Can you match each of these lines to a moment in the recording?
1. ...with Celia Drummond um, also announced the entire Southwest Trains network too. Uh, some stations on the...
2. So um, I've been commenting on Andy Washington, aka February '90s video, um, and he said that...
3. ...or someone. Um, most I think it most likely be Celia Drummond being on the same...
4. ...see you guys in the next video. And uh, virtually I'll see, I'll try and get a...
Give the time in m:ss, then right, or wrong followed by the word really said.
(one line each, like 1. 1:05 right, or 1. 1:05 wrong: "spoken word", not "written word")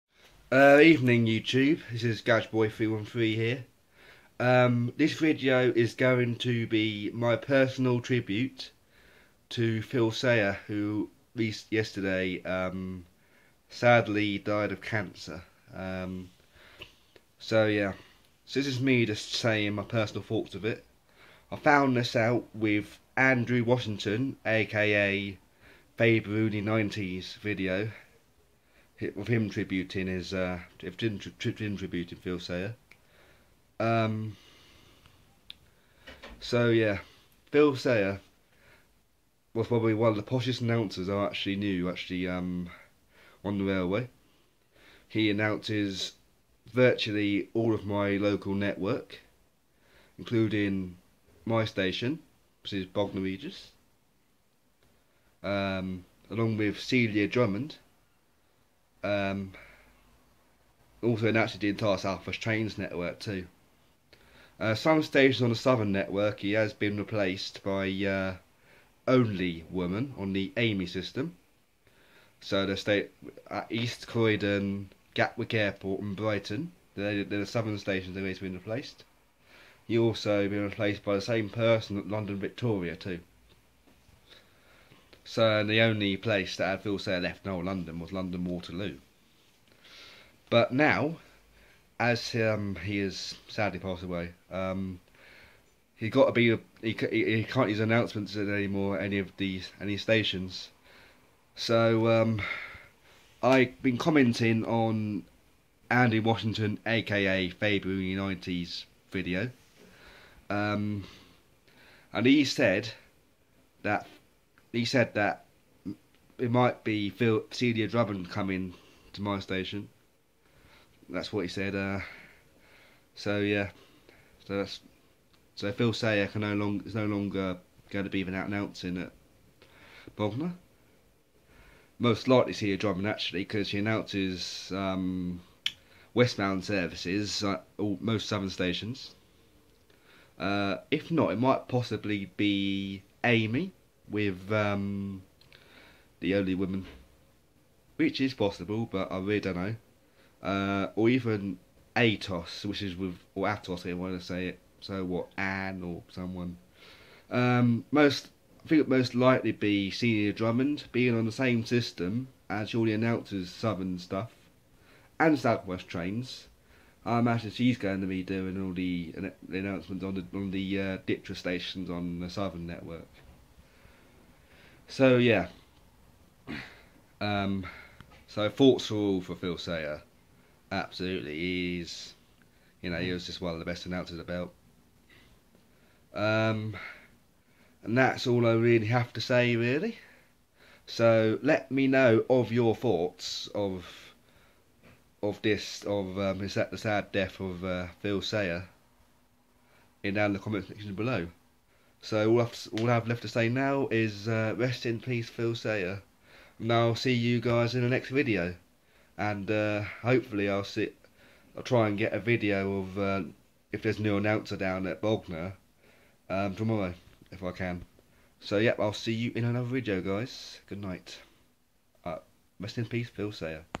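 1. 0:56 right
2. 1:41 right
3. 2:35 right
4. 3:26 wrong: "hopefully", not "virtually".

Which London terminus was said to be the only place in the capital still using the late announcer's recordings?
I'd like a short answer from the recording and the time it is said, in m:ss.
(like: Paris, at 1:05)
London Waterloo, at 1:28.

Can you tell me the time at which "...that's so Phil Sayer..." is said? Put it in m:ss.
2:04.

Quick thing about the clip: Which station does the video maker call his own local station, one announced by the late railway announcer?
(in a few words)
Bognor Regis.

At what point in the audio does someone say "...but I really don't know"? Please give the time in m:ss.
2:28.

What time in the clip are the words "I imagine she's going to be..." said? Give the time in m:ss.
2:47.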